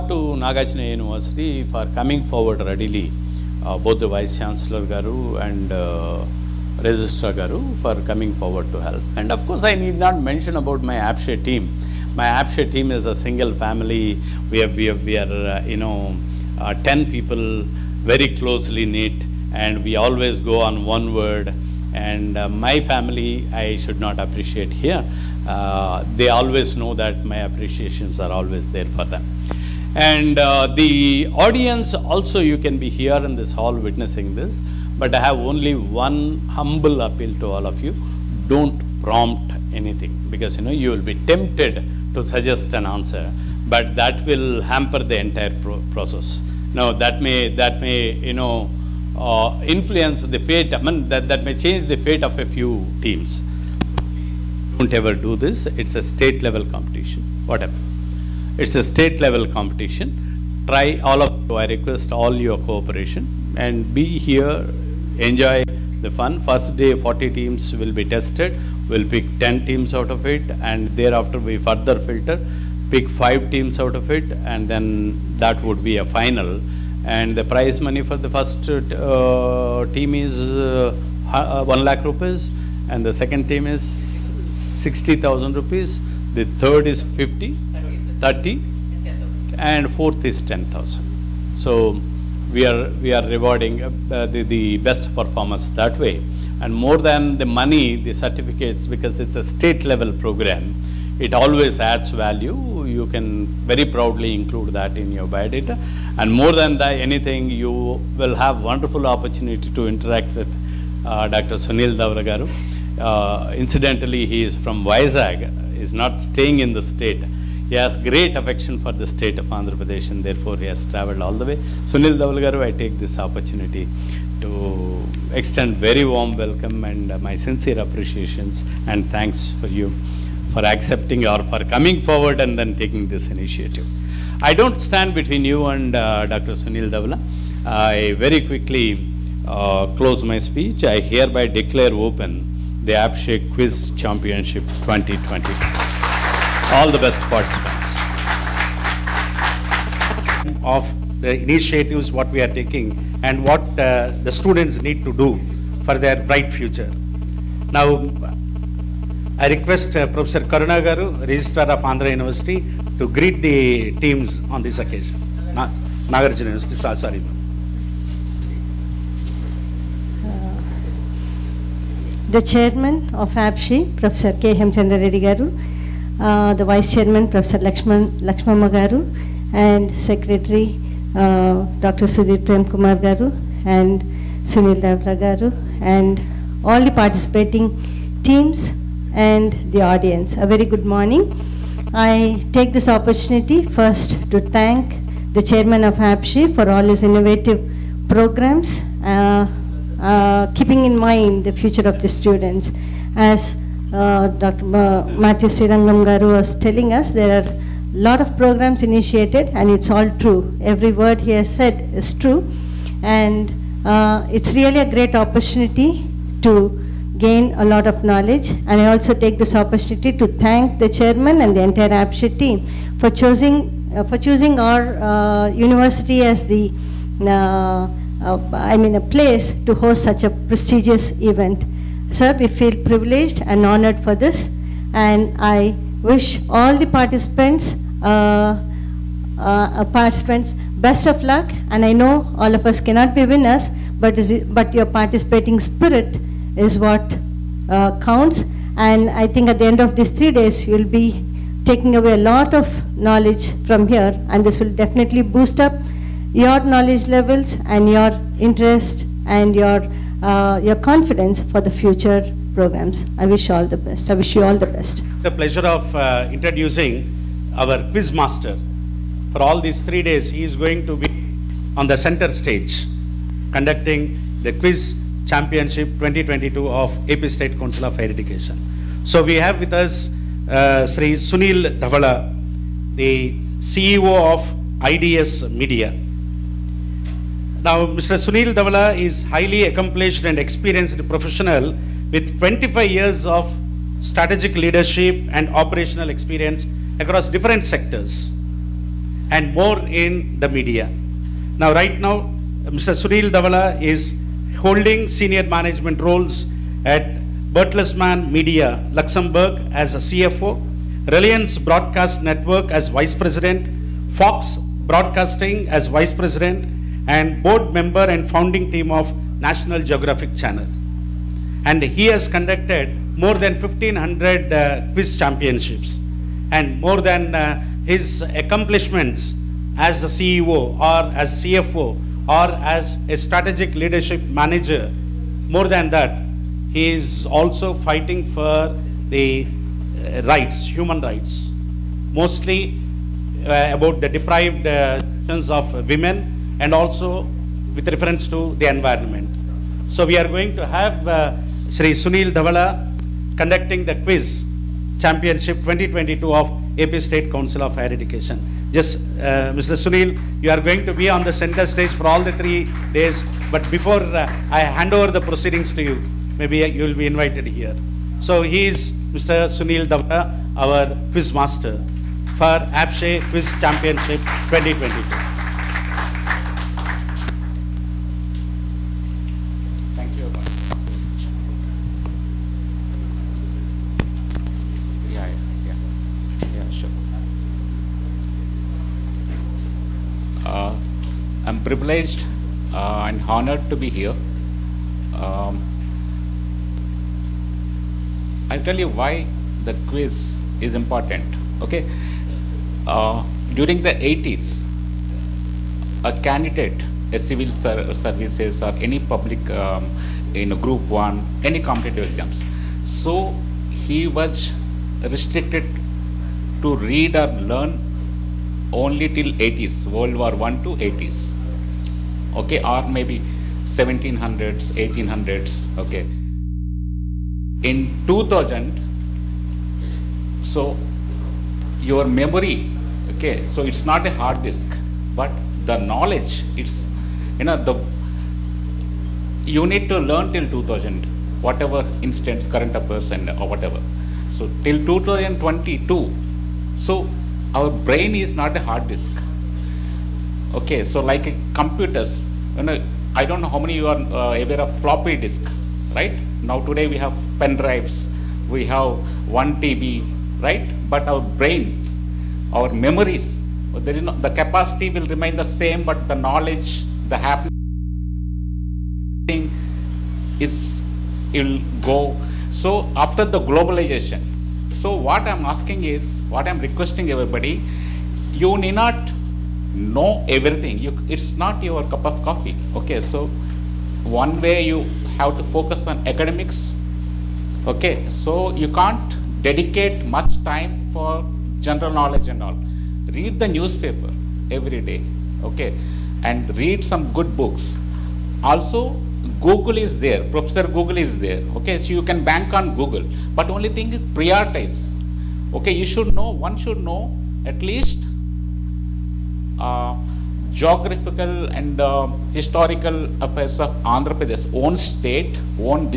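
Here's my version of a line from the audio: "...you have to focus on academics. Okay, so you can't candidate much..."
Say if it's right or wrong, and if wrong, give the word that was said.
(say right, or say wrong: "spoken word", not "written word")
wrong: "dedicate", not "candidate".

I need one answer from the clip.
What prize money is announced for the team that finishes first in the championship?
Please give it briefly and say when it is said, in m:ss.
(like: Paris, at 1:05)
1 lakh rupees, at 1:21.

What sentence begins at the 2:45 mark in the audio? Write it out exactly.
Na Nagarjuna University, sorry, sorry uh, the chairman of APSCHE, Professor K.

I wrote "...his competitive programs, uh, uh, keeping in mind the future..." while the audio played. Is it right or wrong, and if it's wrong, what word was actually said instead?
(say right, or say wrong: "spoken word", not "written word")
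wrong: "innovative", not "competitive".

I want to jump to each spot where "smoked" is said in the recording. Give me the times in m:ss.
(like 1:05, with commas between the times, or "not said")
not said.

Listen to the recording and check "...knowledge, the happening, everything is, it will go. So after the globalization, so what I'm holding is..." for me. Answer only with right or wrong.
wrong.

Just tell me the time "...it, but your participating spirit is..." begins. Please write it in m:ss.
4:04.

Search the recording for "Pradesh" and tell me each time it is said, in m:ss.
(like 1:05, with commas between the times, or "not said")
1:59, 8:34.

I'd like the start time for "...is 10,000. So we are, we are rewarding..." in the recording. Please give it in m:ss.
1:30.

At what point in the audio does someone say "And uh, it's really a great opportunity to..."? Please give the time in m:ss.
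3:33.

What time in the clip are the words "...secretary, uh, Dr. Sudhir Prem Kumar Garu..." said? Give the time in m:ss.
2:59.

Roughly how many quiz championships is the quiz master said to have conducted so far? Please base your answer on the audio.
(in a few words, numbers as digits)
1,500.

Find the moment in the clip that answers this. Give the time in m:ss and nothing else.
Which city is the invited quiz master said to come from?
1:54.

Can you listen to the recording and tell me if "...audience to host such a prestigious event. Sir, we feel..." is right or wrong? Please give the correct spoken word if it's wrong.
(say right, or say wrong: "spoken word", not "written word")
wrong: "place", not "audience".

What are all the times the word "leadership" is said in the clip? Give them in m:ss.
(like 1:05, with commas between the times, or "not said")
4:54, 5:33.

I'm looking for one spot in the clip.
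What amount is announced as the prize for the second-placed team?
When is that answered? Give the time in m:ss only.
1:23.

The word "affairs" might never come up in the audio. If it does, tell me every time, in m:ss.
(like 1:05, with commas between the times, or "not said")
7:22, 8:33.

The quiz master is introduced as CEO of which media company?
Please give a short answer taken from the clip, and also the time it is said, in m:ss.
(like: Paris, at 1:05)
IDS Media, at 4:44.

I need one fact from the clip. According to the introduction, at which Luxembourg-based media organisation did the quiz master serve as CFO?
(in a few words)
Bertelsmann Media.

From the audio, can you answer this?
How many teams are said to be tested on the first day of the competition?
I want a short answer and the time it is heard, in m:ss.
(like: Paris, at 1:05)
40, at 1:06.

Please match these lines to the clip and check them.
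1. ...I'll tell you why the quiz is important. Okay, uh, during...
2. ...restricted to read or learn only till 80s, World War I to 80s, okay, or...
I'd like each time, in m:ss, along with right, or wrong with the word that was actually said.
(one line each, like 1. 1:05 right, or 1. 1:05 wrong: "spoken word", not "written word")
1. 6:38 right
2. 6:55 right.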